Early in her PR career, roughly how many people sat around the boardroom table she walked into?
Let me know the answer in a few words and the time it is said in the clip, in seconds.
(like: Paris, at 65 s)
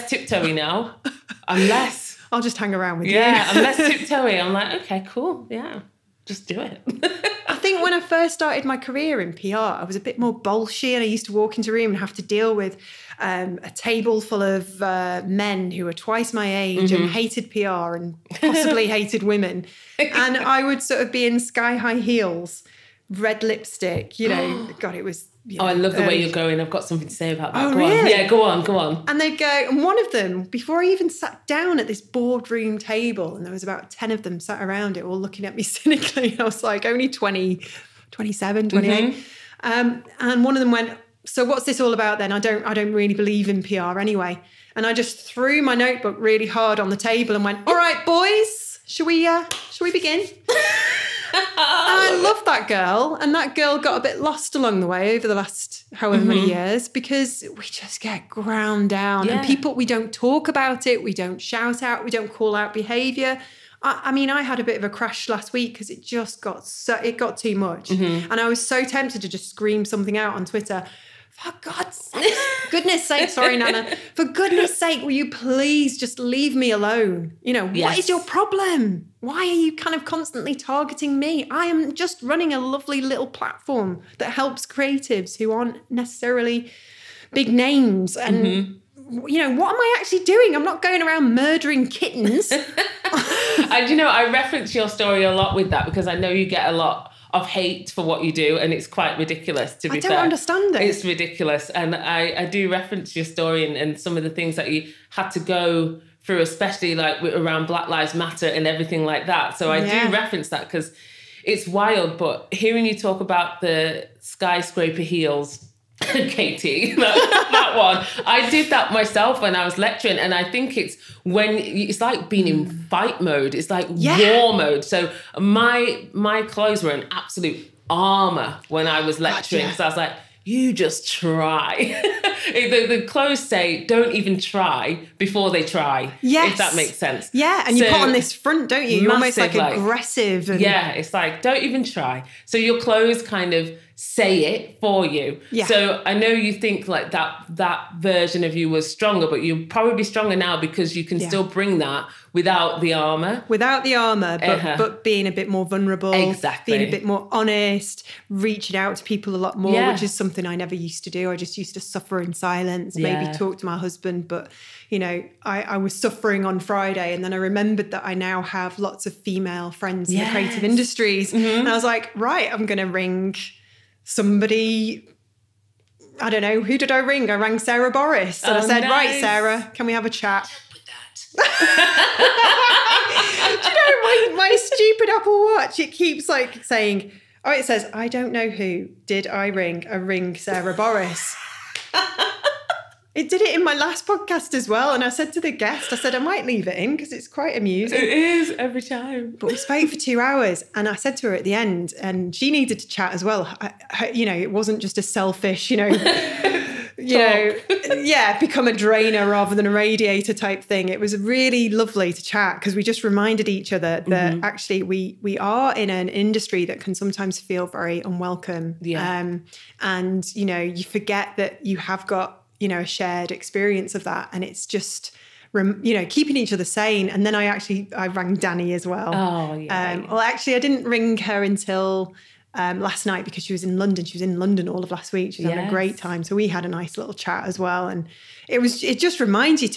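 10, at 33 s.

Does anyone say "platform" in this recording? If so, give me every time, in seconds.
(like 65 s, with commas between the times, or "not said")
83 s.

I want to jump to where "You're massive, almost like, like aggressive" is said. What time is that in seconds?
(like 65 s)
139 s.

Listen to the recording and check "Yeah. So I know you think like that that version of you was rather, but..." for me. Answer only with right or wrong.
wrong.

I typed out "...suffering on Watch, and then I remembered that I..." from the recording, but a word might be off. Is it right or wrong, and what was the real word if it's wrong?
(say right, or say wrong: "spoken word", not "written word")
wrong: "Friday", not "Watch".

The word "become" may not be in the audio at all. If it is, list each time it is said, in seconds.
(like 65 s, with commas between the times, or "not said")
208 s.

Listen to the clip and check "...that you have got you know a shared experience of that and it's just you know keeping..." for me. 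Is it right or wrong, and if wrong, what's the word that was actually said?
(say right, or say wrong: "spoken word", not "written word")
right.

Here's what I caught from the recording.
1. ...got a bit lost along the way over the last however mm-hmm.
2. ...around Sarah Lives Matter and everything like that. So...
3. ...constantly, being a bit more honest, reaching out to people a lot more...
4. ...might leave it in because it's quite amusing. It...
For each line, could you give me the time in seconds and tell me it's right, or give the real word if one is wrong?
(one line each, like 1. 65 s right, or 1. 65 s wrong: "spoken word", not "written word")
1. 53 s right
2. 107 s wrong: "Black", not "Sarah"
3. 156 s wrong: "exactly", not "constantly"
4. 196 s right.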